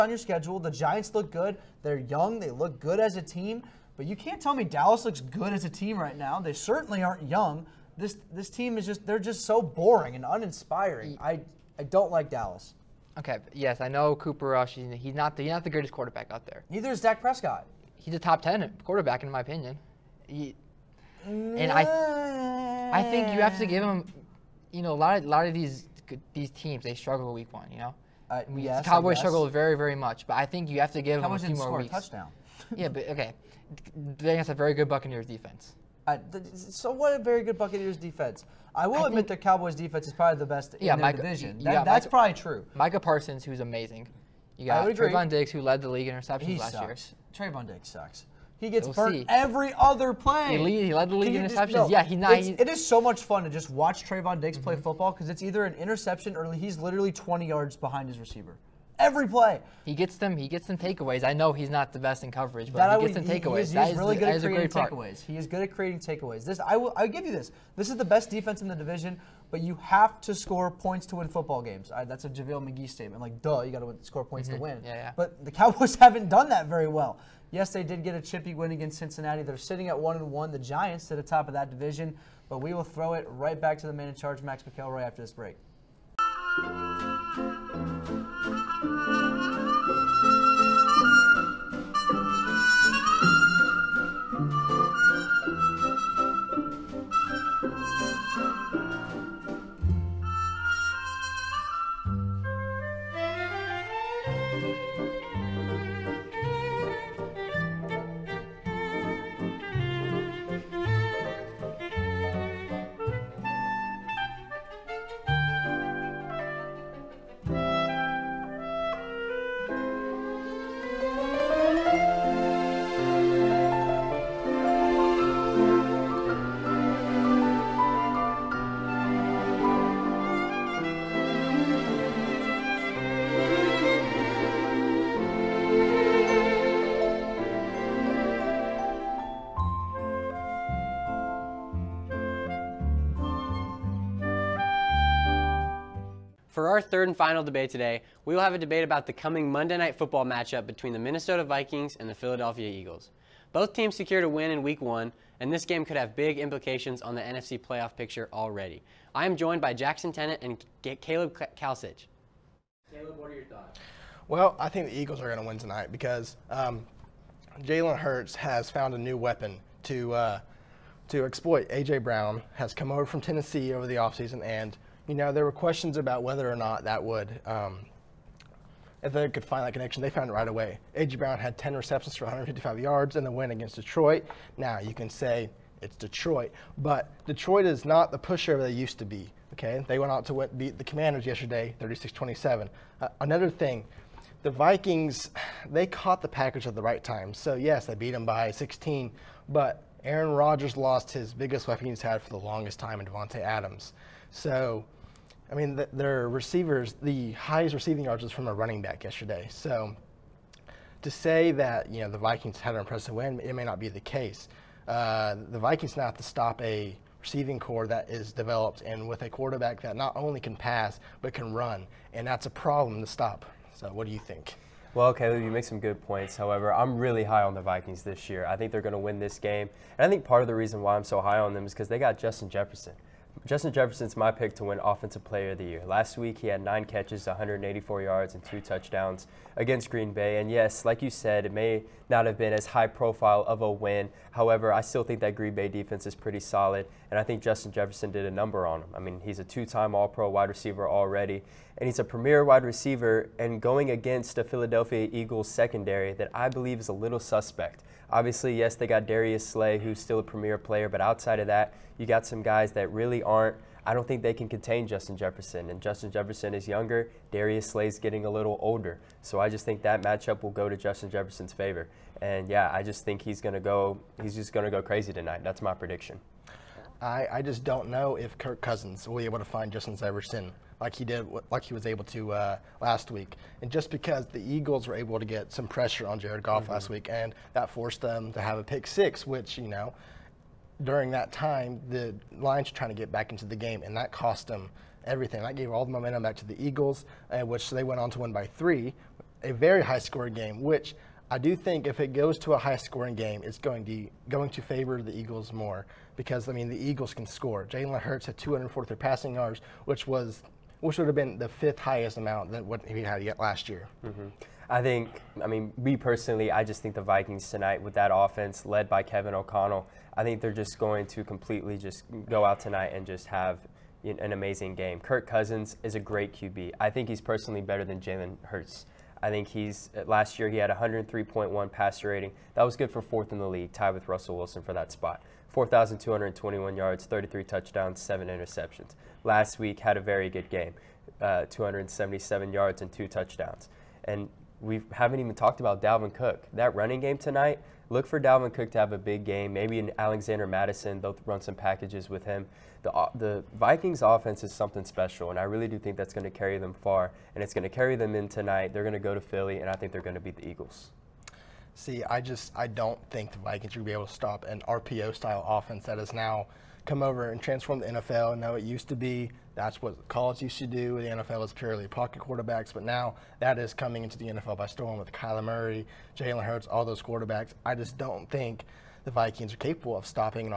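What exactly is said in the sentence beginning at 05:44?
And we haven't even talked about Dalvin Cook.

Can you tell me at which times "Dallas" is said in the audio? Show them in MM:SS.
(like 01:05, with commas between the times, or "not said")
00:04, 00:12.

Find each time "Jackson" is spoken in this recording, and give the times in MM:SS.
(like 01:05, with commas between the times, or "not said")
02:39.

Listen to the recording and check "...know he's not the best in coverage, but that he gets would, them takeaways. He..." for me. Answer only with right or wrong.
right.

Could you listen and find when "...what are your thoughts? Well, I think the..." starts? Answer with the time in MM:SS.
02:43.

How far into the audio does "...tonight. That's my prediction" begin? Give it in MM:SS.
04:35.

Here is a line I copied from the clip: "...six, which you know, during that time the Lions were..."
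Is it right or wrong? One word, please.
right.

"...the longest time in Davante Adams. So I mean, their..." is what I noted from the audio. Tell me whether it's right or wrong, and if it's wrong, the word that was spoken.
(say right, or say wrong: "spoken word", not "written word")
right.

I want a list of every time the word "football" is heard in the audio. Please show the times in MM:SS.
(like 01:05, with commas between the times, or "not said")
00:54, 01:11, 02:29.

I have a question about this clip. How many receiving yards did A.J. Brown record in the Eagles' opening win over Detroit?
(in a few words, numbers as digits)
155.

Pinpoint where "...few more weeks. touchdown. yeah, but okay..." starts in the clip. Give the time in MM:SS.
00:31.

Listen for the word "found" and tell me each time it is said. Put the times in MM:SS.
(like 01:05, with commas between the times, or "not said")
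02:48, 03:00.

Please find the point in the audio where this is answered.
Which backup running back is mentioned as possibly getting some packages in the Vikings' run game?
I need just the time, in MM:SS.
05:49.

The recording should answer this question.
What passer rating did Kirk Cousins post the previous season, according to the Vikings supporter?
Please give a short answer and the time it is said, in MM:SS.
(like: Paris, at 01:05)
103.1, at 05:30.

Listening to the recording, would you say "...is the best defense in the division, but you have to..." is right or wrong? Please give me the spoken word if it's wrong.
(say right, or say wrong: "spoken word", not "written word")
right.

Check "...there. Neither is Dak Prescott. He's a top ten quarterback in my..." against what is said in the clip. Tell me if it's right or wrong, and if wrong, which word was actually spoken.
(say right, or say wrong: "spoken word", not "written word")
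right.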